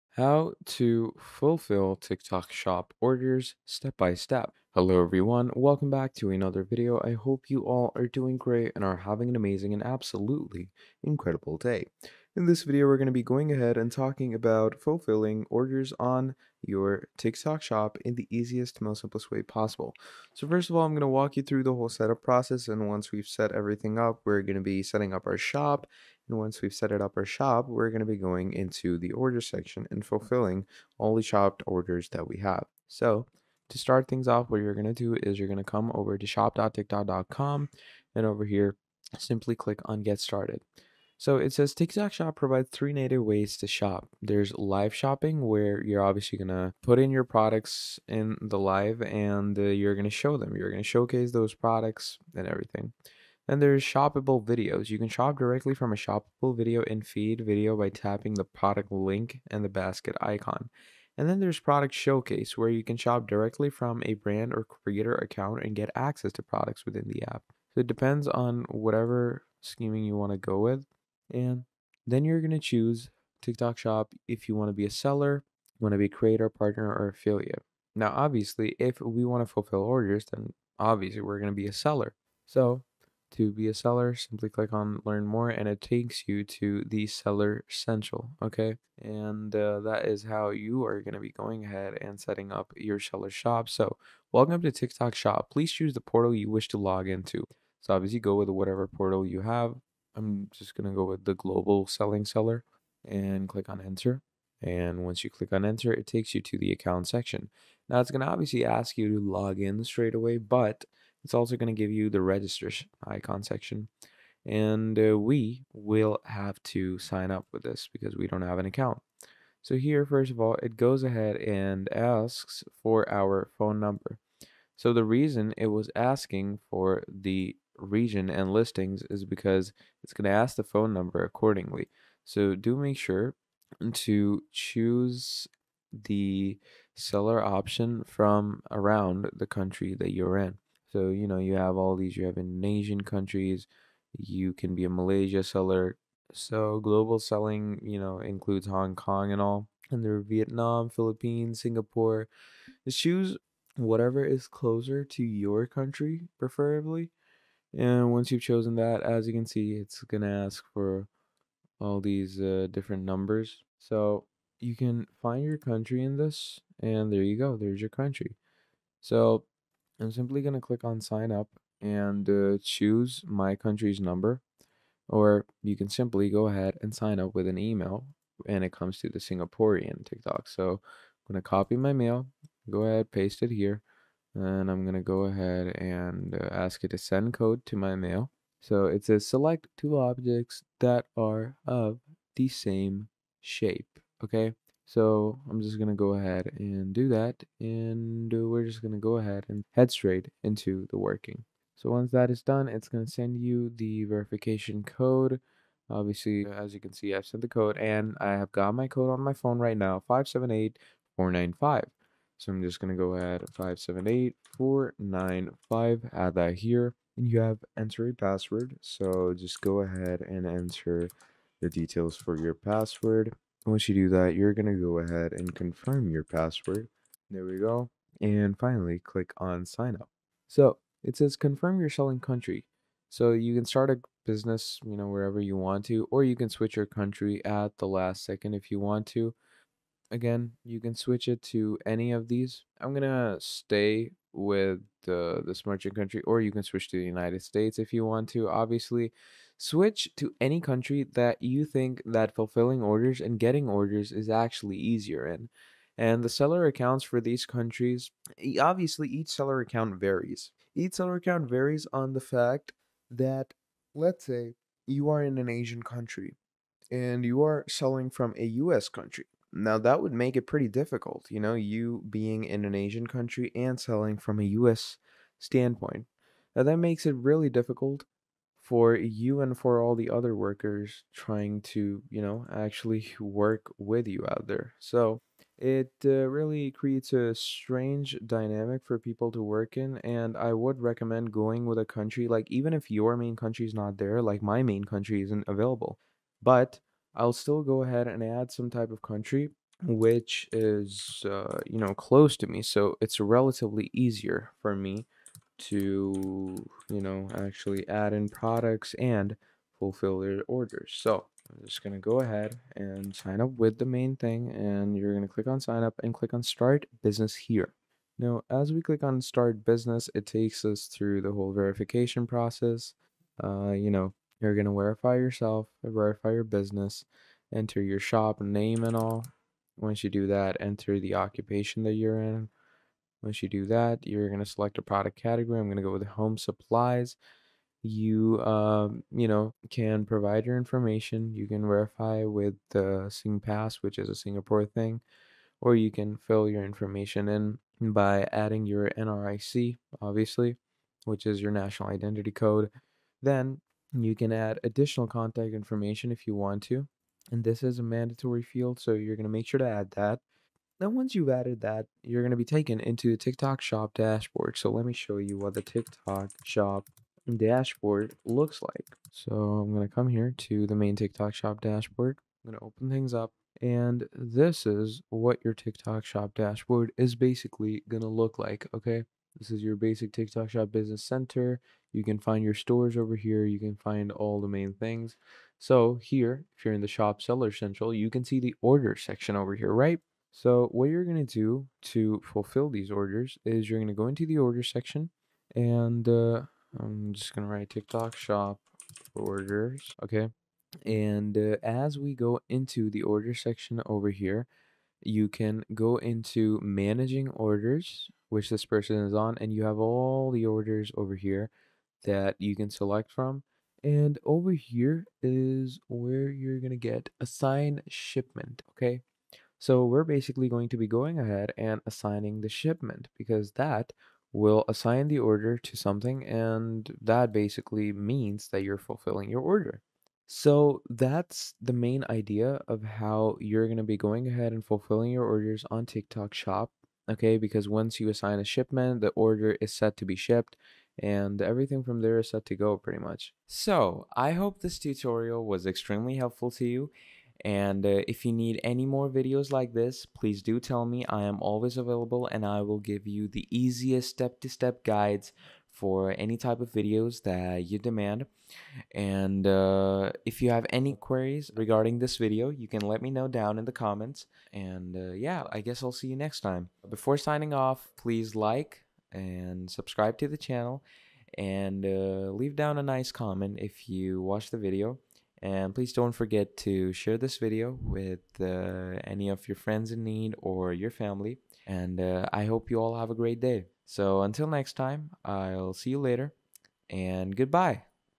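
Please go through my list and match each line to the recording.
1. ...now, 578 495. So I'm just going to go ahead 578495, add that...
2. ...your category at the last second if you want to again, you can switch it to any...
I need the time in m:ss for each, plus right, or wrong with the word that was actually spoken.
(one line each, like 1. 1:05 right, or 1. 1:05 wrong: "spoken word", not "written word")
1. 3:29 right
2. 3:56 wrong: "country", not "category".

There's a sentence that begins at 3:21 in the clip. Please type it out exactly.
So once that is done, it's going to send you the verification code.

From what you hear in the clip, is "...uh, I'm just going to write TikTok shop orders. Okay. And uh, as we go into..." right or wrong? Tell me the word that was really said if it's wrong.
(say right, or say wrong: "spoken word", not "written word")
right.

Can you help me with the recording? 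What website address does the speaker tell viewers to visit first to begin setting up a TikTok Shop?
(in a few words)
shop.tiktok.com.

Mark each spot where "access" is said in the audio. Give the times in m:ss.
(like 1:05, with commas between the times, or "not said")
1:05.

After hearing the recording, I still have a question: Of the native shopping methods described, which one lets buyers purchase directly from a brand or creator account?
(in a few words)
Product showcase.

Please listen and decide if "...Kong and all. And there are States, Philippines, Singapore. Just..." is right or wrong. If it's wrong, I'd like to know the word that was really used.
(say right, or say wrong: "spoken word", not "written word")
wrong: "Vietnam", not "States".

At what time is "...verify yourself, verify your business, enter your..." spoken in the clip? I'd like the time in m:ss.
5:24.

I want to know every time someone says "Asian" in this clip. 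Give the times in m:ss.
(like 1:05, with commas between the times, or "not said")
2:22, 4:25, 4:32.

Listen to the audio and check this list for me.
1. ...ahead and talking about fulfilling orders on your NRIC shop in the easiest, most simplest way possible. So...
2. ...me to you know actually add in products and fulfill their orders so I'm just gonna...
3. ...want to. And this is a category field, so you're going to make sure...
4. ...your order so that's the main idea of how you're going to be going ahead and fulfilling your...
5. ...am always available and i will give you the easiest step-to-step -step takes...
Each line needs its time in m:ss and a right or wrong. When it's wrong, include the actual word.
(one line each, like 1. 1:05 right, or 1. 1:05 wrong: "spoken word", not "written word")
1. 0:13 wrong: "TikTok", not "NRIC"
2. 5:04 right
3. 5:56 wrong: "mandatory", not "category"
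4. 7:09 right
5. 7:31 wrong: "guides", not "takes".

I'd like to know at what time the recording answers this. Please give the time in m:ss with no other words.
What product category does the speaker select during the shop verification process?
5:36.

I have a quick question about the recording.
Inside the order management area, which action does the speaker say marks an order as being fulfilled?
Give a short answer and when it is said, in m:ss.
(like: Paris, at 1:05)
Assign shipment, at 6:57.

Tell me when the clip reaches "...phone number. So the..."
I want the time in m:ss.
2:03.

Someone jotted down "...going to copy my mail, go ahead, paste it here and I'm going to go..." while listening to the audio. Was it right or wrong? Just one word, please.
right.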